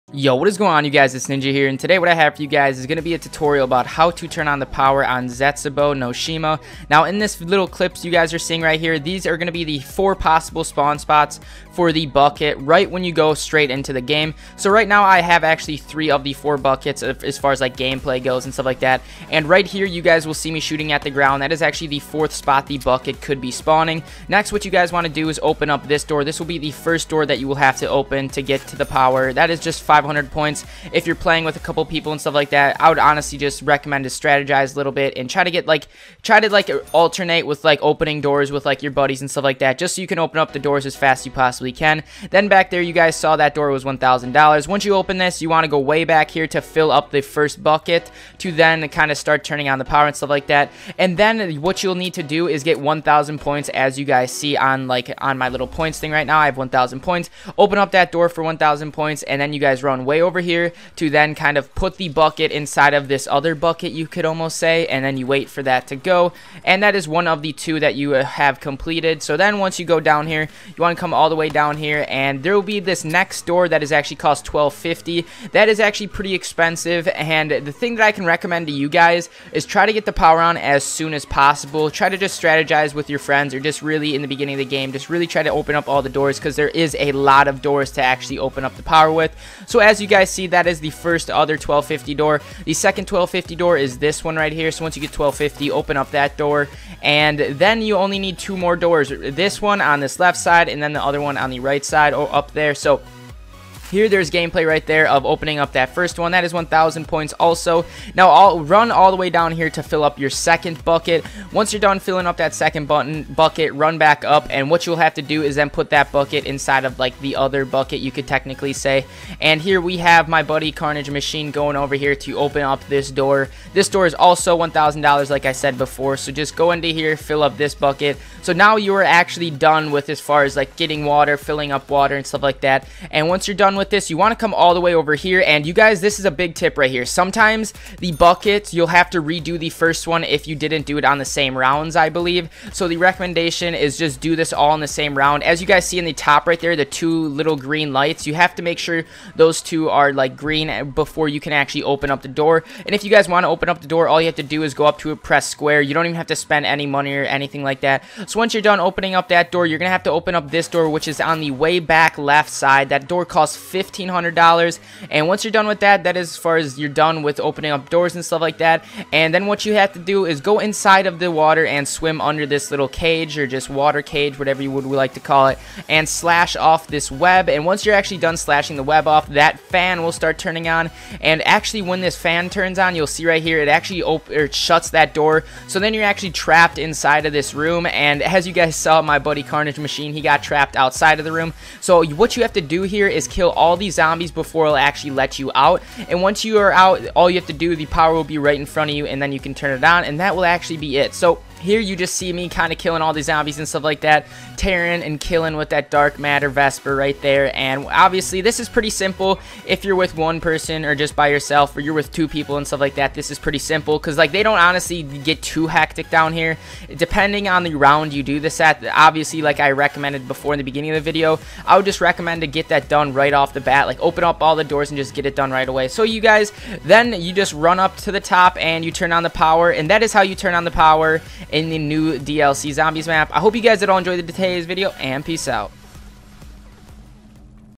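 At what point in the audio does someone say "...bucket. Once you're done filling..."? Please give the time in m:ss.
1:50.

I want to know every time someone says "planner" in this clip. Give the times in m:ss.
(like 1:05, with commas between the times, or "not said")
not said.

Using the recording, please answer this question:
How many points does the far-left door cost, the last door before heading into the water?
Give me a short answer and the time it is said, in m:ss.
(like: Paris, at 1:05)
1500, at 2:43.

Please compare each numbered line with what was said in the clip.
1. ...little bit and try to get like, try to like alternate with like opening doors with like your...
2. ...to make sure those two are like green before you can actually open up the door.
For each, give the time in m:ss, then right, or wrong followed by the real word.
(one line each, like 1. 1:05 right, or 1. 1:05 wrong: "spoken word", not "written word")
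1. 0:34 right
2. 2:28 right.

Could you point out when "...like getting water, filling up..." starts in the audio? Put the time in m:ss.
2:10.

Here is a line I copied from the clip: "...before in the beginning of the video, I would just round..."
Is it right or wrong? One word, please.
wrong.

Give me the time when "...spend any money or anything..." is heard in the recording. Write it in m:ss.
2:36.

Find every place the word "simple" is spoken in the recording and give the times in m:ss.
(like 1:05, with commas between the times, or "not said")
3:28, 3:33.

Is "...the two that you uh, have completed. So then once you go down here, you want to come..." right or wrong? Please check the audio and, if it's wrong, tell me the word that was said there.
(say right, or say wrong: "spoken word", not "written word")
right.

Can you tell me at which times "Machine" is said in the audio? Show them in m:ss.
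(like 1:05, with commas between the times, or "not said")
2:01, 3:09.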